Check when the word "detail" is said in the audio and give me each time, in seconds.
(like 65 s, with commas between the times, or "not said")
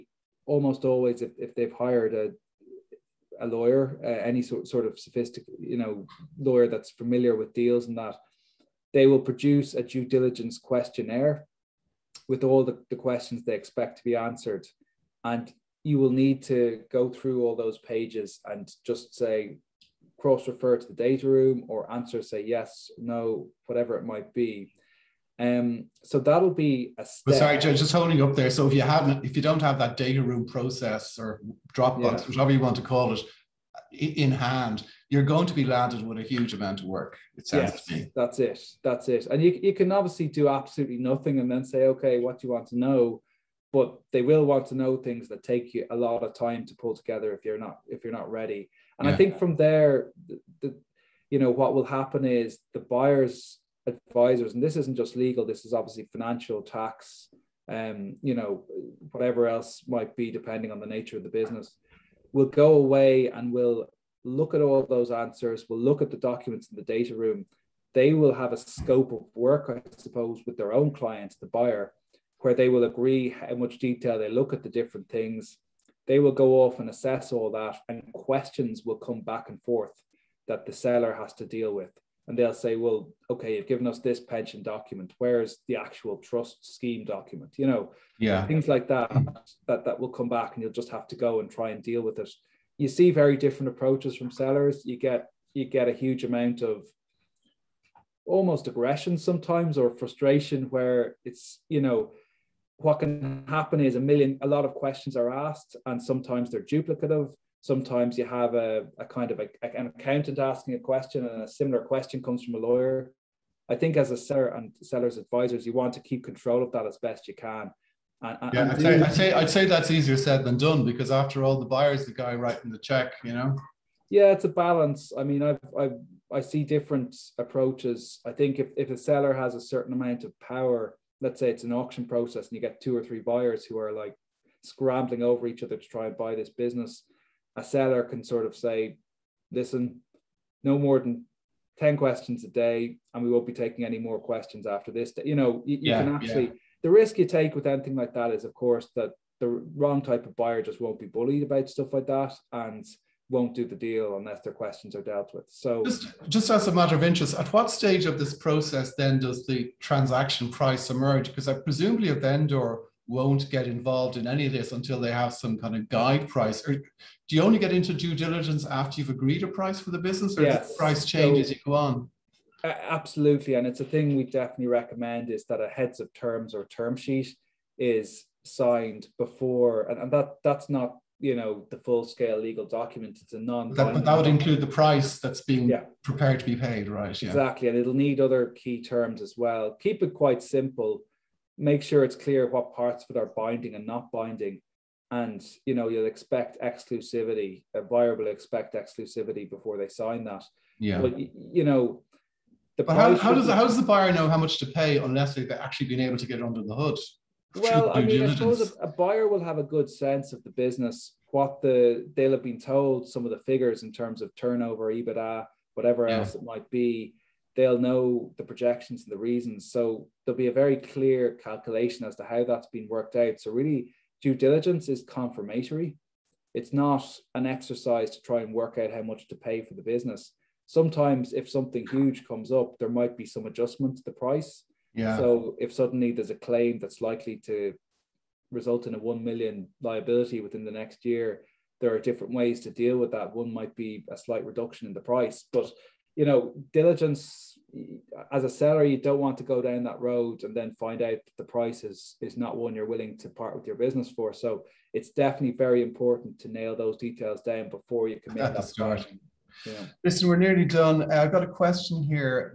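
73 s, 256 s.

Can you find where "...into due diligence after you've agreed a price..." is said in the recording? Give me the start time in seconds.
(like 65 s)
167 s.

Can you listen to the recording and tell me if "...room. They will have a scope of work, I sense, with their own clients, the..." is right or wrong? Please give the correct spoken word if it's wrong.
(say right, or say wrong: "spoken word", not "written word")
wrong: "suppose", not "sense".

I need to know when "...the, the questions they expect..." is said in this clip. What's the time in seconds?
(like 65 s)
12 s.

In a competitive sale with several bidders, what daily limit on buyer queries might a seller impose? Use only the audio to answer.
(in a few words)
10 questions a day.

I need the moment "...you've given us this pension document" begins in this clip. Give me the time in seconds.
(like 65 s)
83 s.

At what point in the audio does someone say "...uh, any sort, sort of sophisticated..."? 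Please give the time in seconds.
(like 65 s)
4 s.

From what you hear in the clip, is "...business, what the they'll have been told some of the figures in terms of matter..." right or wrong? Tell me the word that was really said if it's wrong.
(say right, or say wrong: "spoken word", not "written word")
wrong: "turnover", not "matter".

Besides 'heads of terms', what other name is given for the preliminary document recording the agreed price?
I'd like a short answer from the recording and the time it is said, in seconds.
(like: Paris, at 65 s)
term sheet, at 176 s.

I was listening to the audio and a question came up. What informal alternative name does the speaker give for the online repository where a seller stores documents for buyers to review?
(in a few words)
Dropbox.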